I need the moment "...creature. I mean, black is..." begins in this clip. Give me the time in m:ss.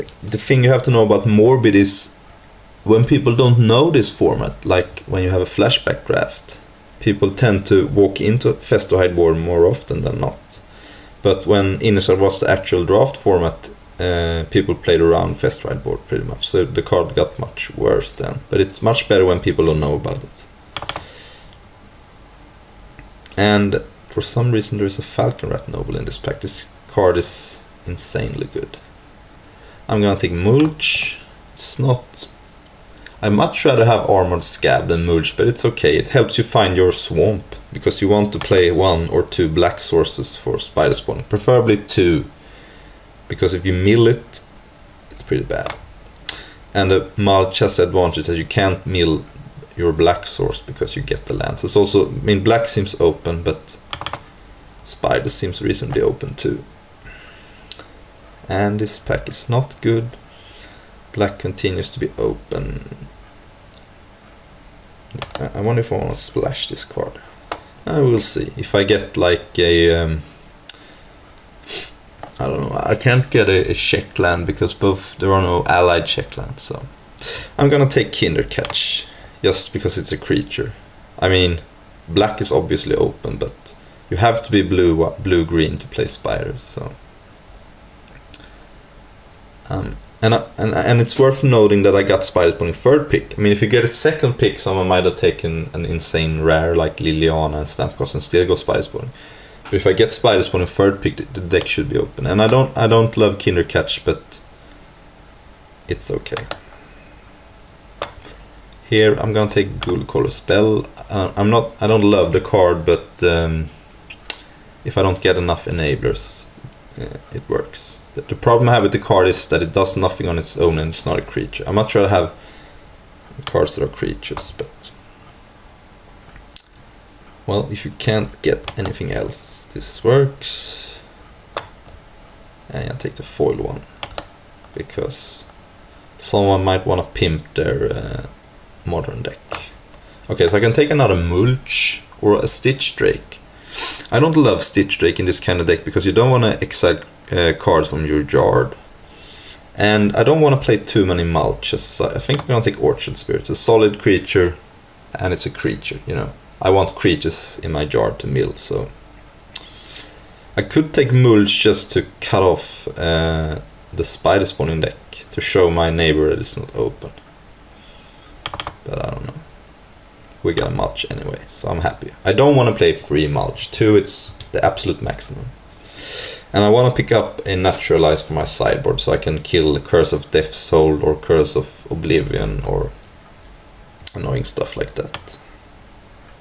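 1:20.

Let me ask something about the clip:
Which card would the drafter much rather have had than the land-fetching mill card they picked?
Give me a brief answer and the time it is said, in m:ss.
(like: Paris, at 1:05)
Armored Skaab, at 0:34.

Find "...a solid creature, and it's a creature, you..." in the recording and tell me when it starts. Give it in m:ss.
2:33.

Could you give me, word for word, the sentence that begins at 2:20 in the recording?
Okay, so I can take another mulch or a stitched drake.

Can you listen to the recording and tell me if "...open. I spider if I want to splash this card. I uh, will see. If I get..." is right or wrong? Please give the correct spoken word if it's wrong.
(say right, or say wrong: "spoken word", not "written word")
wrong: "wonder", not "spider".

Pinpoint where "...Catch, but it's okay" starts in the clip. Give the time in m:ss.
1:43.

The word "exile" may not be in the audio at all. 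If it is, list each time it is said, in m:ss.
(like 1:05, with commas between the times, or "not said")
2:26.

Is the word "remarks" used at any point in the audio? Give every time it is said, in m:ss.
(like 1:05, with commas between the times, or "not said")
not said.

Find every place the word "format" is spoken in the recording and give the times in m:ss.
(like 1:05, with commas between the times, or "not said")
0:04, 0:13.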